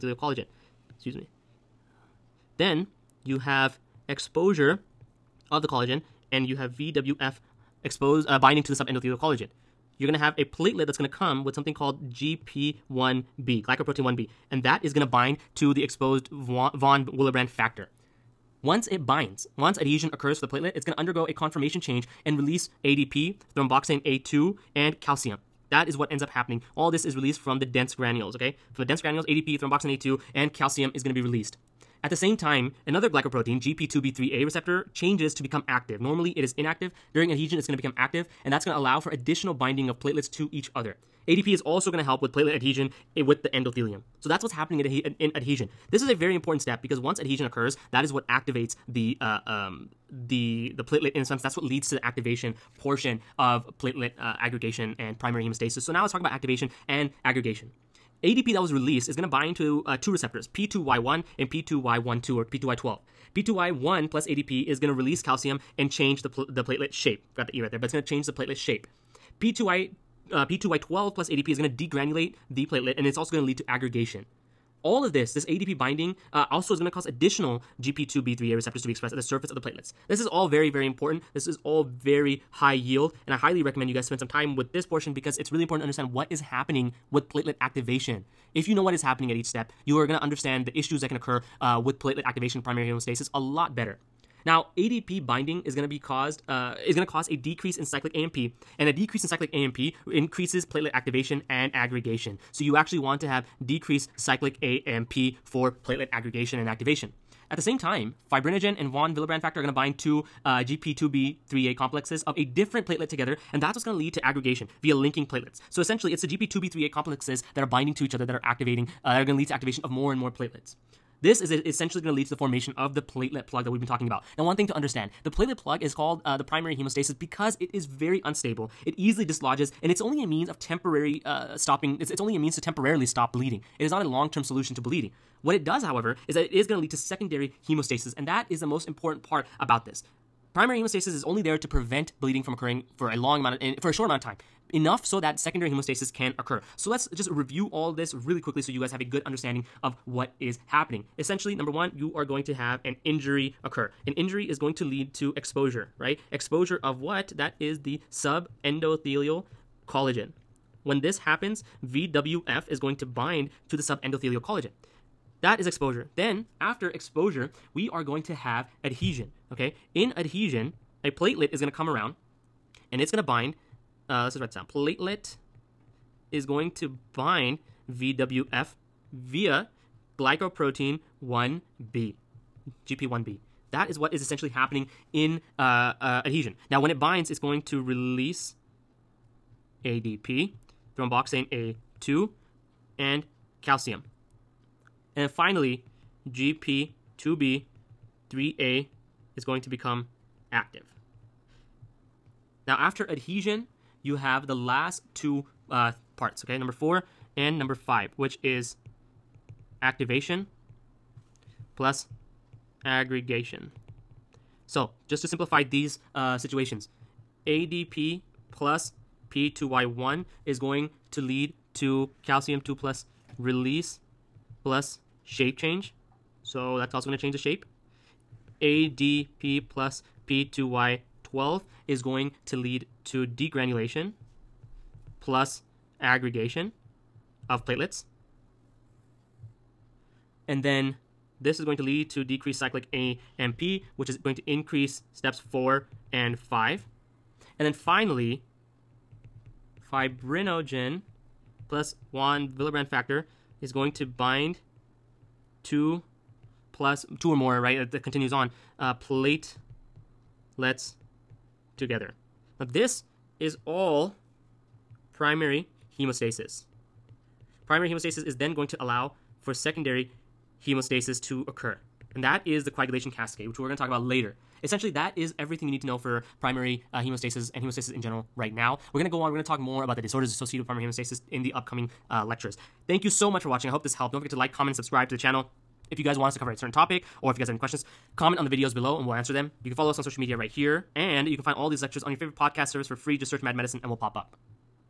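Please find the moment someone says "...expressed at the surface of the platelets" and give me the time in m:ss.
1:18.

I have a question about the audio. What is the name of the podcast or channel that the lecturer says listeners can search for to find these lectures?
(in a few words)
Mad Medicine.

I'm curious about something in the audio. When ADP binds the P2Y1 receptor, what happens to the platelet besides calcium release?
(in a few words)
Shape change.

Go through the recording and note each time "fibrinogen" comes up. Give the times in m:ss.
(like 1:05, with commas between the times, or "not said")
1:48, 4:09.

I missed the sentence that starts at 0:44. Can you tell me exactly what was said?
So that's what's happening in, adhesion.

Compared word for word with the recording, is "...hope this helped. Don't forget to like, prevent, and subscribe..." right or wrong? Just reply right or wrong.
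wrong.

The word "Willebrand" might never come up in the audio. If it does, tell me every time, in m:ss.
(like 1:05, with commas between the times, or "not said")
0:17, 1:49, 4:12.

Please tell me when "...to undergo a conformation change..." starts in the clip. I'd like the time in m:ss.
0:20.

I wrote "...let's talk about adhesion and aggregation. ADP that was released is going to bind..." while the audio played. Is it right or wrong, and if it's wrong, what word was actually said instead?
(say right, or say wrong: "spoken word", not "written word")
wrong: "activation", not "adhesion".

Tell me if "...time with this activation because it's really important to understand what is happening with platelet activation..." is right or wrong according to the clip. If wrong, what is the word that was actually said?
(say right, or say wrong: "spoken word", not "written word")
wrong: "portion", not "activation".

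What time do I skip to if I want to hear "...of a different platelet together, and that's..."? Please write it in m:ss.
1:52.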